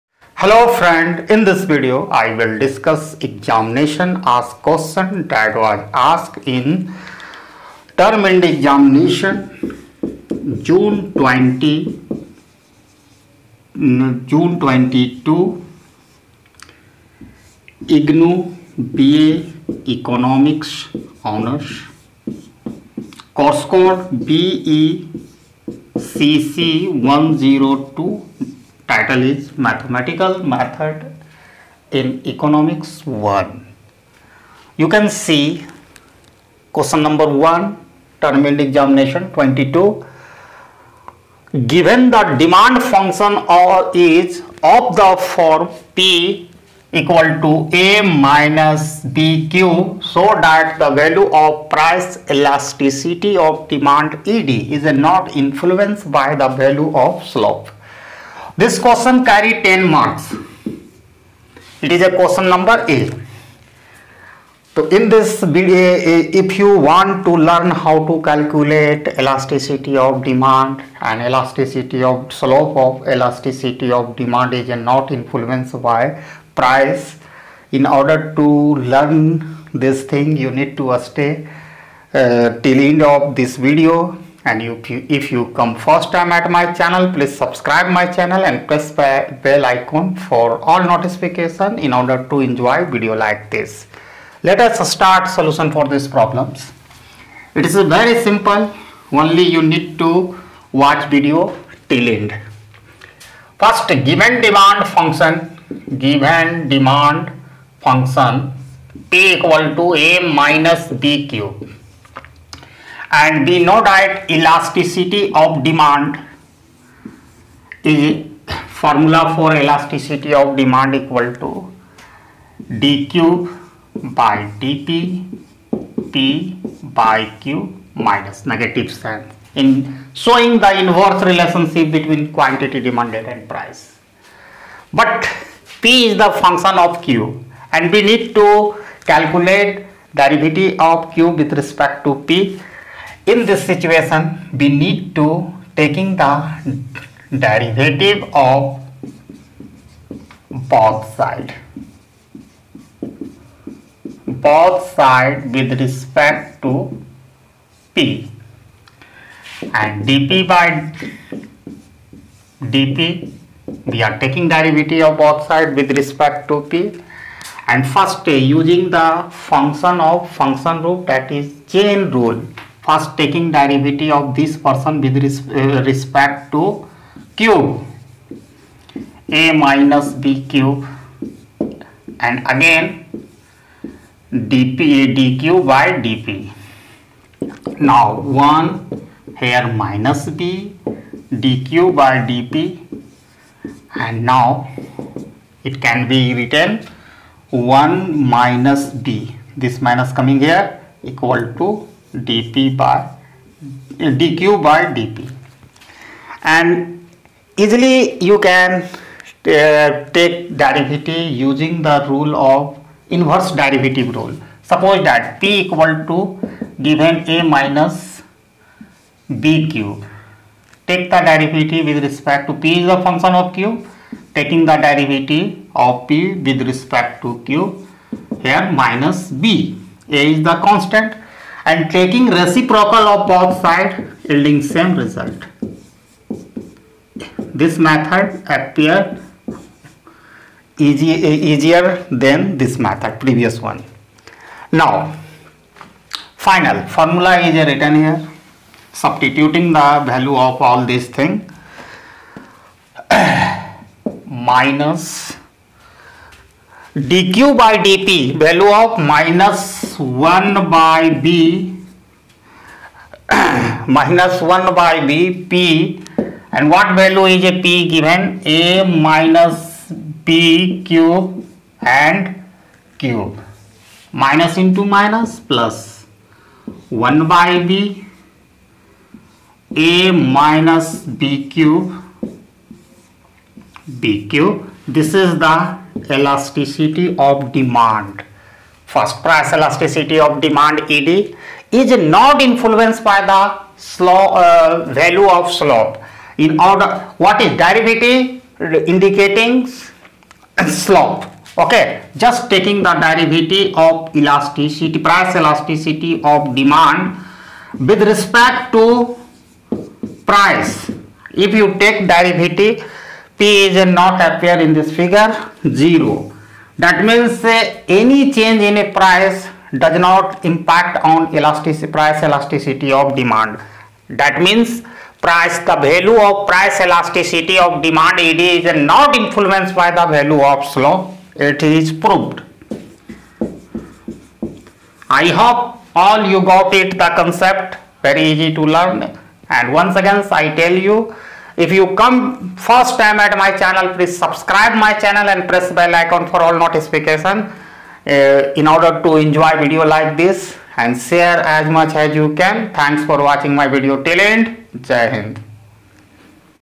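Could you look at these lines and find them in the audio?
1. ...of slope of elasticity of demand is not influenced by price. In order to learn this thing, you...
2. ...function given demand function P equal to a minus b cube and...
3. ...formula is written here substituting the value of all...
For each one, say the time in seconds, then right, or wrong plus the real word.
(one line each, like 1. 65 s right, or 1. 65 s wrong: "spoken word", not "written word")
1. 72 s right
2. 104 s right
3. 246 s right.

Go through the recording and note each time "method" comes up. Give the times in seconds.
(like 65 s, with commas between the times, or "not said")
30 s, 237 s, 242 s.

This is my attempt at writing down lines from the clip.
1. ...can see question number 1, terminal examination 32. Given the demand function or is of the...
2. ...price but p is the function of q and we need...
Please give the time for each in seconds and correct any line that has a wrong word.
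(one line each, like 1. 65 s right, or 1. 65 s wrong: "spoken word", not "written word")
1. 34 s wrong: "22", not "32"
2. 133 s right.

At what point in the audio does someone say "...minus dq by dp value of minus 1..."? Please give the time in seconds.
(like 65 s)
254 s.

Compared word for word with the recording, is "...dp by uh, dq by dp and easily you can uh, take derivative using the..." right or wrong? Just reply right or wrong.
right.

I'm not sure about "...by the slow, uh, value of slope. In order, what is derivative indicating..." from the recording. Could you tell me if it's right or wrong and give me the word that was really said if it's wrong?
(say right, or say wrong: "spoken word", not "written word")
right.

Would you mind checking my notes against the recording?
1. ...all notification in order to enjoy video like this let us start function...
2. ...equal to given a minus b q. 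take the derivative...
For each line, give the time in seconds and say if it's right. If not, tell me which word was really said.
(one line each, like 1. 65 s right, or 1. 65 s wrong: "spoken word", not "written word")
1. 90 s wrong: "solution", not "function"
2. 215 s right.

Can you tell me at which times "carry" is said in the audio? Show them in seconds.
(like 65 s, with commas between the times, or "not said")
59 s.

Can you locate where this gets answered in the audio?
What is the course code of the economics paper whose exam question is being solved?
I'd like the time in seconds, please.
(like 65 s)
24 s.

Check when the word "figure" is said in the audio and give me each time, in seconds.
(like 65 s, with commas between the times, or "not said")
314 s.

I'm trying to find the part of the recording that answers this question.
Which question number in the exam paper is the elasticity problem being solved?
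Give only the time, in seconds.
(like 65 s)
62 s.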